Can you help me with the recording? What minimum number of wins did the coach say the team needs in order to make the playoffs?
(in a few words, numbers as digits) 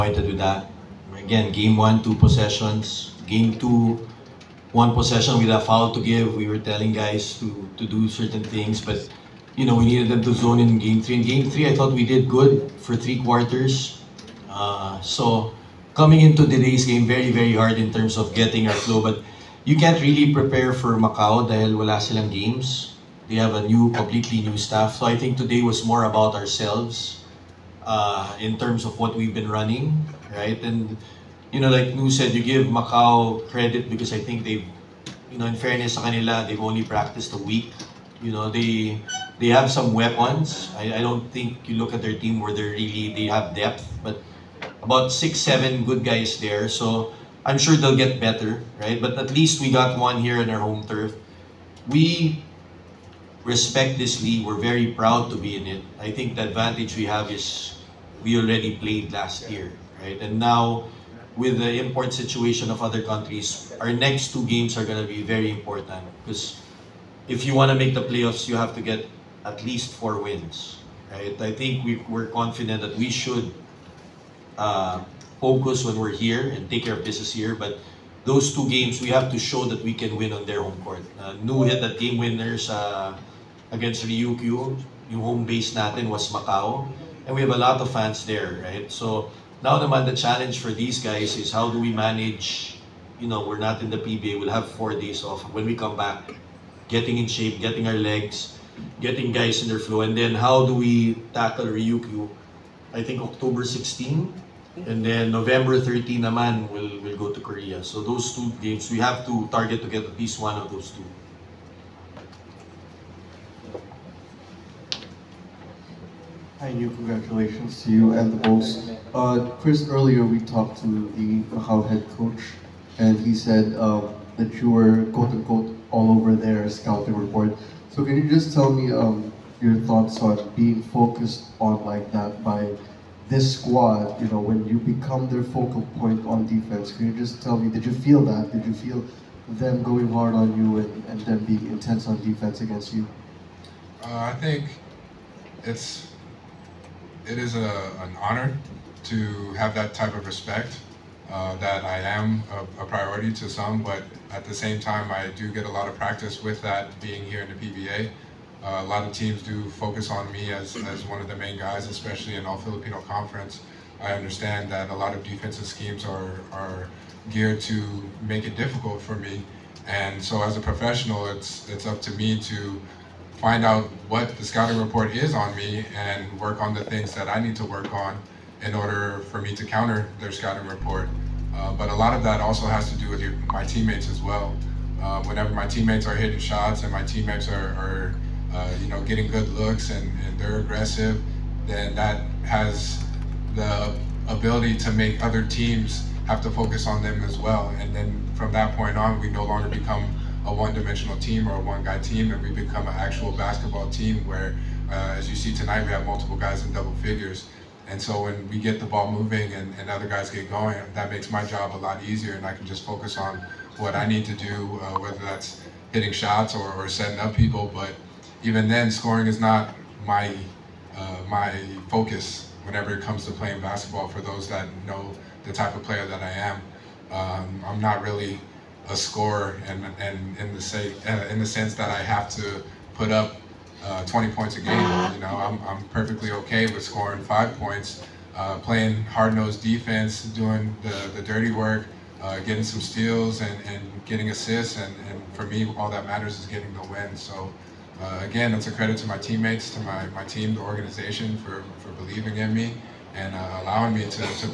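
4.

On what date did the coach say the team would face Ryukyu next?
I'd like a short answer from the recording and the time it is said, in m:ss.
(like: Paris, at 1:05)
October 16, at 1:43.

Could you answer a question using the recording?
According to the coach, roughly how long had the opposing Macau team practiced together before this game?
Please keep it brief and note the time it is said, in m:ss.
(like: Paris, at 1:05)
a week, at 0:37.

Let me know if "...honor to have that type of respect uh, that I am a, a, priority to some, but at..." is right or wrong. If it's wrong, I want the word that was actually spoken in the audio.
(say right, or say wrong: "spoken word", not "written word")
right.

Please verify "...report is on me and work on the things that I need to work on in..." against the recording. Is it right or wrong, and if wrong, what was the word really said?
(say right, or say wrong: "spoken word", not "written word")
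right.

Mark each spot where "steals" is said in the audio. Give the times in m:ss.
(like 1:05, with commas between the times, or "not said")
4:02.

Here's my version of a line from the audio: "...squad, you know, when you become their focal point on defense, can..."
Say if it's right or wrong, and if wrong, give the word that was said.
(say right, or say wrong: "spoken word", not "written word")
right.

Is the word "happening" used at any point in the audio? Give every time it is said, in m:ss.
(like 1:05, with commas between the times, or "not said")
not said.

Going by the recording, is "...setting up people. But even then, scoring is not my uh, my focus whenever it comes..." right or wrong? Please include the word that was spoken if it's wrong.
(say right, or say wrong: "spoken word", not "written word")
right.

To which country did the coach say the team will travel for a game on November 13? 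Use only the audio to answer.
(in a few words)
Korea.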